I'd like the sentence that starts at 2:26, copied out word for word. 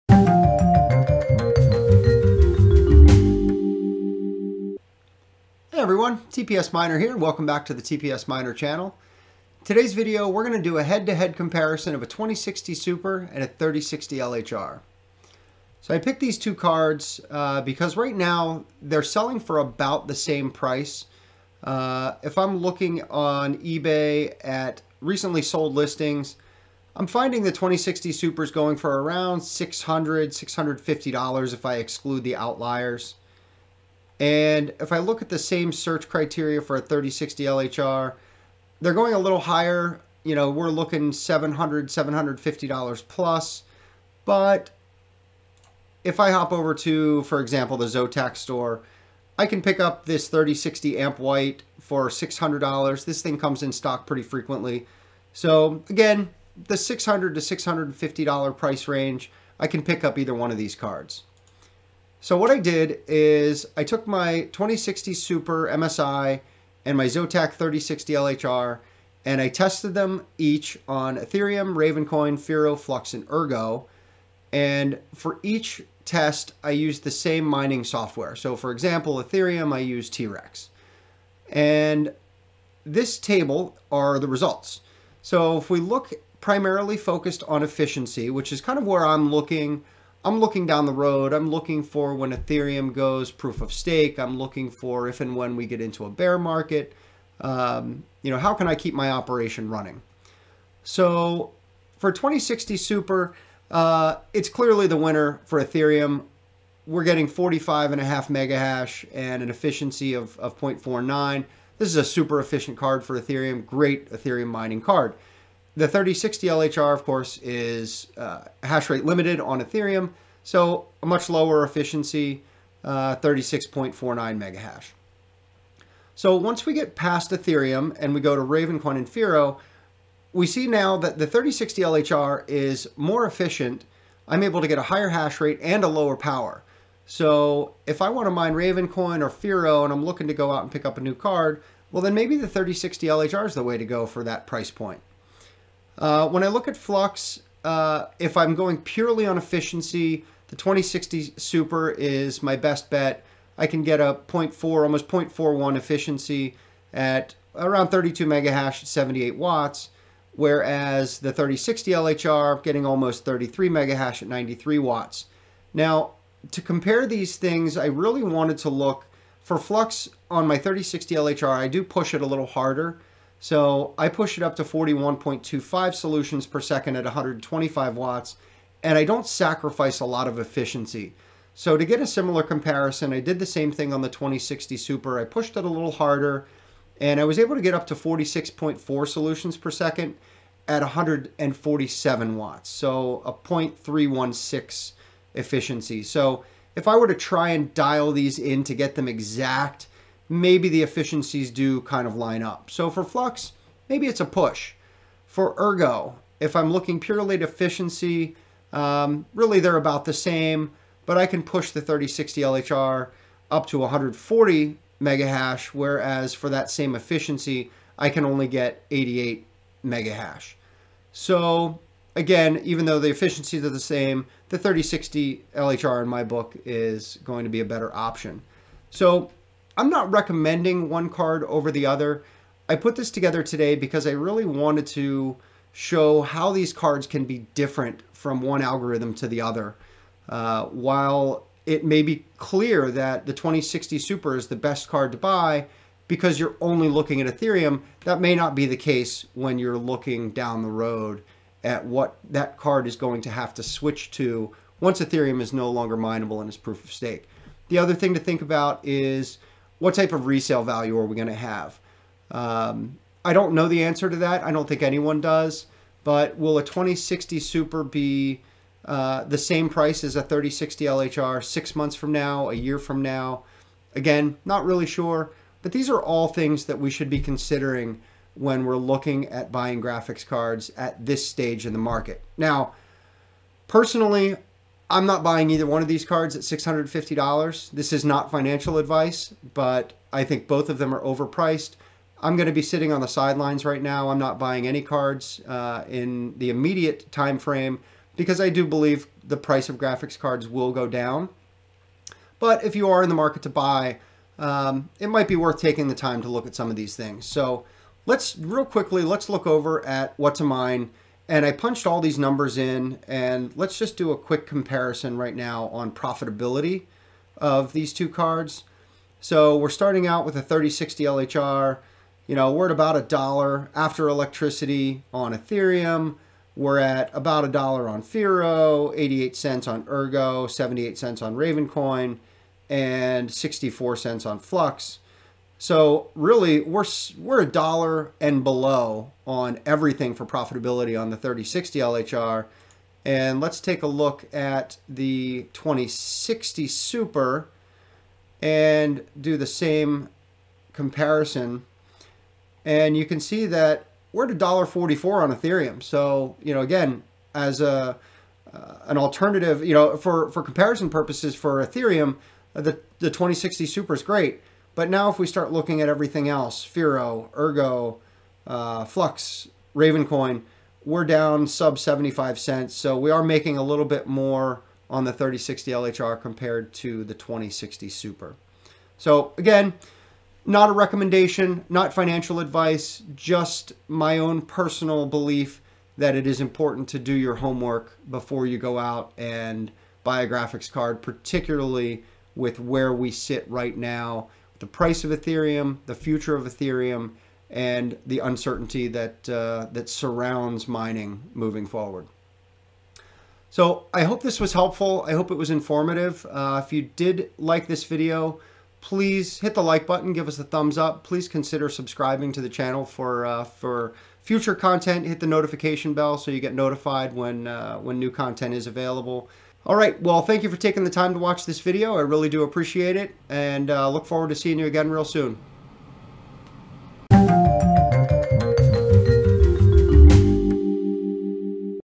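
Uh, when I look at Flux, uh, if I'm going purely on efficiency, the 2060 Super is my best bet.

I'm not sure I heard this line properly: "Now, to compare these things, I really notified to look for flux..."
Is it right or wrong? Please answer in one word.
wrong.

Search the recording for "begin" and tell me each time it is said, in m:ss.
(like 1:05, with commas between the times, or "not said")
not said.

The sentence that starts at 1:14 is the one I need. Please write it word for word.
And for each test, I used the same mining software.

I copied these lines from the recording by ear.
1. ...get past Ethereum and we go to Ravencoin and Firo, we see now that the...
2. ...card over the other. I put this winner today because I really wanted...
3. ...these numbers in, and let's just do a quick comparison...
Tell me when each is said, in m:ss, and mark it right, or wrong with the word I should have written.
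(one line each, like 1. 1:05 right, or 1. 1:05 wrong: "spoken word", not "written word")
1. 2:06 right
2. 3:51 wrong: "together", not "winner"
3. 5:12 right.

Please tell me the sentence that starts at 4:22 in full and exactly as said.
Um, I don't know the answer to that.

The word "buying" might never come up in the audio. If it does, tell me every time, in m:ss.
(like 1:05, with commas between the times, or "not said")
4:39, 4:45, 4:54.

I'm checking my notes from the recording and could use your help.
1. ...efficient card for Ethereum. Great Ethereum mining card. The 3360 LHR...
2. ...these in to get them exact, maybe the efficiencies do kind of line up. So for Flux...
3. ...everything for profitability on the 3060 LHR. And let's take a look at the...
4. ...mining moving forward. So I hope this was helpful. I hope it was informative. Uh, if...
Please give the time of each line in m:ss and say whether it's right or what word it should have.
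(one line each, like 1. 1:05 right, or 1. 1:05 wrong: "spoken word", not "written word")
1. 1:52 wrong: "3060", not "3360"
2. 3:18 right
3. 5:39 right
4. 6:40 right.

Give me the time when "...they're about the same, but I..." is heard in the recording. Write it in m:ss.
3:29.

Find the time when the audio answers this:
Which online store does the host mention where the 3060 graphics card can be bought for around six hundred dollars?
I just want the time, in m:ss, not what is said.
0:47.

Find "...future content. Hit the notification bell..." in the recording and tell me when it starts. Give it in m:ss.
6:54.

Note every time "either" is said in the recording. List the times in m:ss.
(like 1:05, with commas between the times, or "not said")
1:00, 4:45.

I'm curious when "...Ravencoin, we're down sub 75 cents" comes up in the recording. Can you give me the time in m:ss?
6:09.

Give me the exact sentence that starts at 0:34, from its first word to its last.
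And if I look at the same search criteria for a 3060 LHR, they're going a little higher.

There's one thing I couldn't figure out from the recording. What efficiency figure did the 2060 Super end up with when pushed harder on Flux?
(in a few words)
0.316.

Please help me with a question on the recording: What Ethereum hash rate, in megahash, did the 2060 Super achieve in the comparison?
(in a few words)
45.5.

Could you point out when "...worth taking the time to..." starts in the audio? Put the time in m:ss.
5:05.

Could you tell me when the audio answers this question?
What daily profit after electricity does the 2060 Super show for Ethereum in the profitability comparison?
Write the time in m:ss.
5:54.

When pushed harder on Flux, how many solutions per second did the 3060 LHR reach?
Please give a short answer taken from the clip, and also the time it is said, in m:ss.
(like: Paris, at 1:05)
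41.25, at 2:54.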